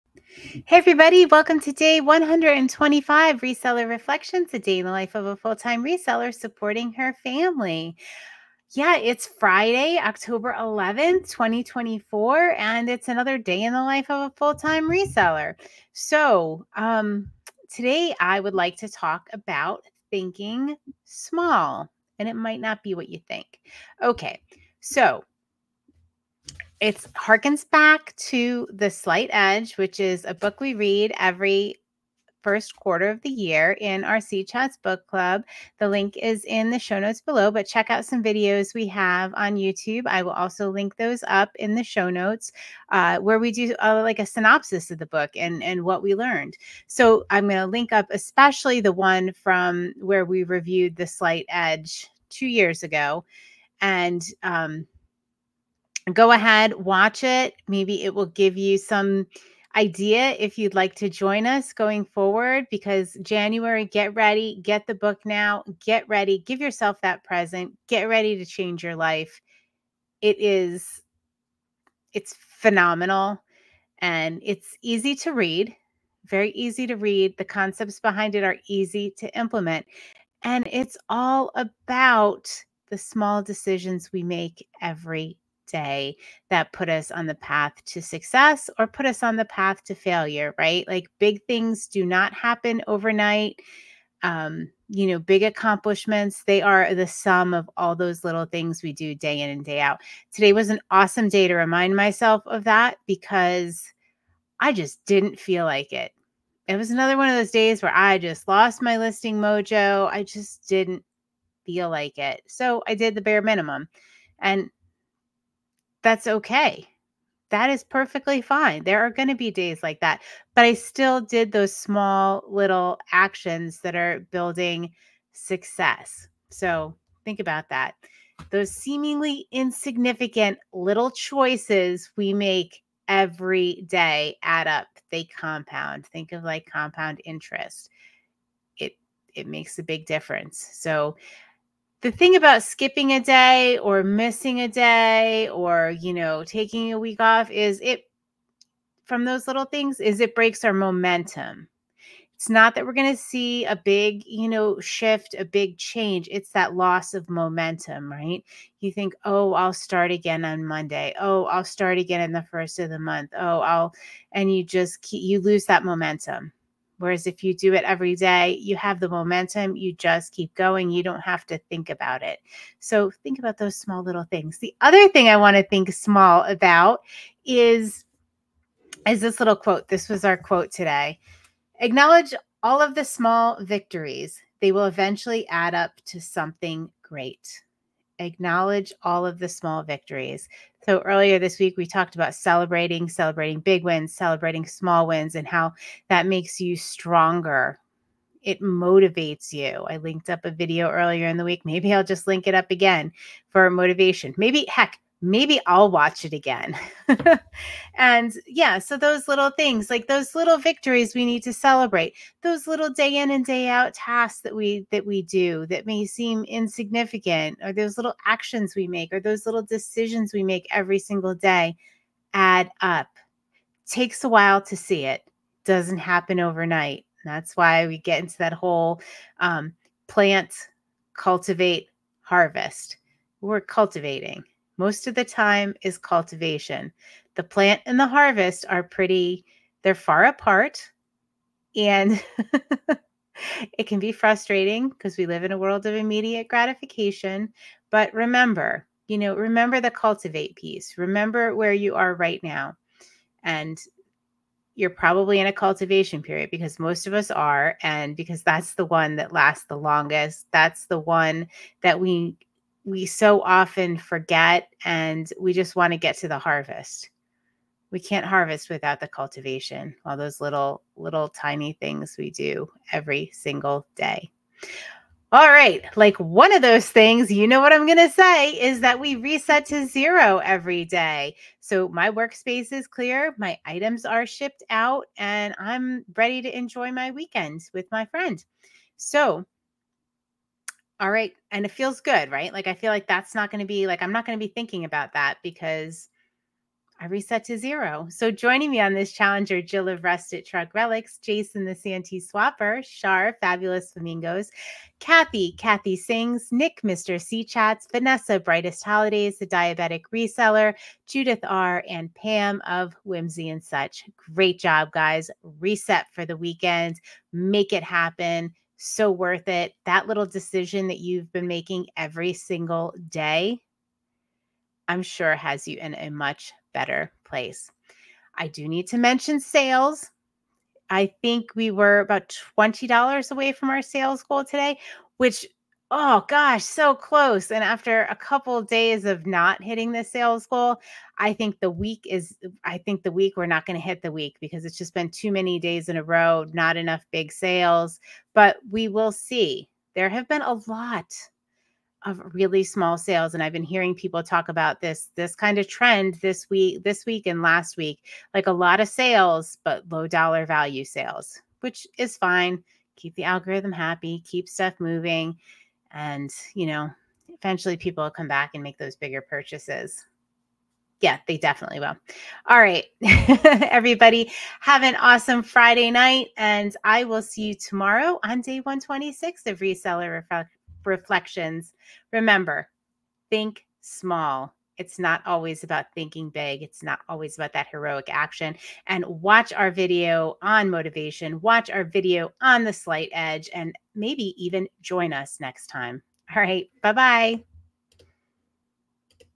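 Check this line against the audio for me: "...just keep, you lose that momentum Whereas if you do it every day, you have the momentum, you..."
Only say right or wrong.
right.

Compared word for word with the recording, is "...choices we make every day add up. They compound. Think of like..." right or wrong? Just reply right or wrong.
right.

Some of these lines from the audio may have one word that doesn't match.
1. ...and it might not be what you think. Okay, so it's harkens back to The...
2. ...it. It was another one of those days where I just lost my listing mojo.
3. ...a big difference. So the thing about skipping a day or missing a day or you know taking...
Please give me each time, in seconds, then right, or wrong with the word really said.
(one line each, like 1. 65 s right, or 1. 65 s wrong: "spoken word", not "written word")
1. 22 s right
2. 105 s right
3. 139 s right.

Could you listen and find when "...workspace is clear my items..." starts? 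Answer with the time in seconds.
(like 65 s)
282 s.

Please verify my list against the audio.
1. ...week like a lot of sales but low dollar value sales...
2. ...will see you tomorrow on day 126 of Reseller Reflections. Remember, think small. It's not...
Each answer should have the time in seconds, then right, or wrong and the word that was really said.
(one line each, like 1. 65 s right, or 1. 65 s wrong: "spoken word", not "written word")
1. 357 s right
2. 377 s right.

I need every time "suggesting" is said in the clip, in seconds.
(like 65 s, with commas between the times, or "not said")
not said.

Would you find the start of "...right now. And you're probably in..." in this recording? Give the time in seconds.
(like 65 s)
252 s.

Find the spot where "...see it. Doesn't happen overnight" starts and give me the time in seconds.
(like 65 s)
224 s.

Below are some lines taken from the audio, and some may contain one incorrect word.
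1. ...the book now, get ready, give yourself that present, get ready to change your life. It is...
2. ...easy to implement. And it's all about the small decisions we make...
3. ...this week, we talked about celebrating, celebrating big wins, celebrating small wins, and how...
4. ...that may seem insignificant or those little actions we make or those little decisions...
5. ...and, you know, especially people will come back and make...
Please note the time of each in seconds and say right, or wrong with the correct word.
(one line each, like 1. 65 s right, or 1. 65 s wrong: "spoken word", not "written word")
1. 64 s right
2. 78 s right
3. 191 s right
4. 215 s right
5. 365 s wrong: "eventually", not "especially".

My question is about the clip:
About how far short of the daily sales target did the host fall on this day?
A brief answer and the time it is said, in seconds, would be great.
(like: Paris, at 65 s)
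$20, at 332 s.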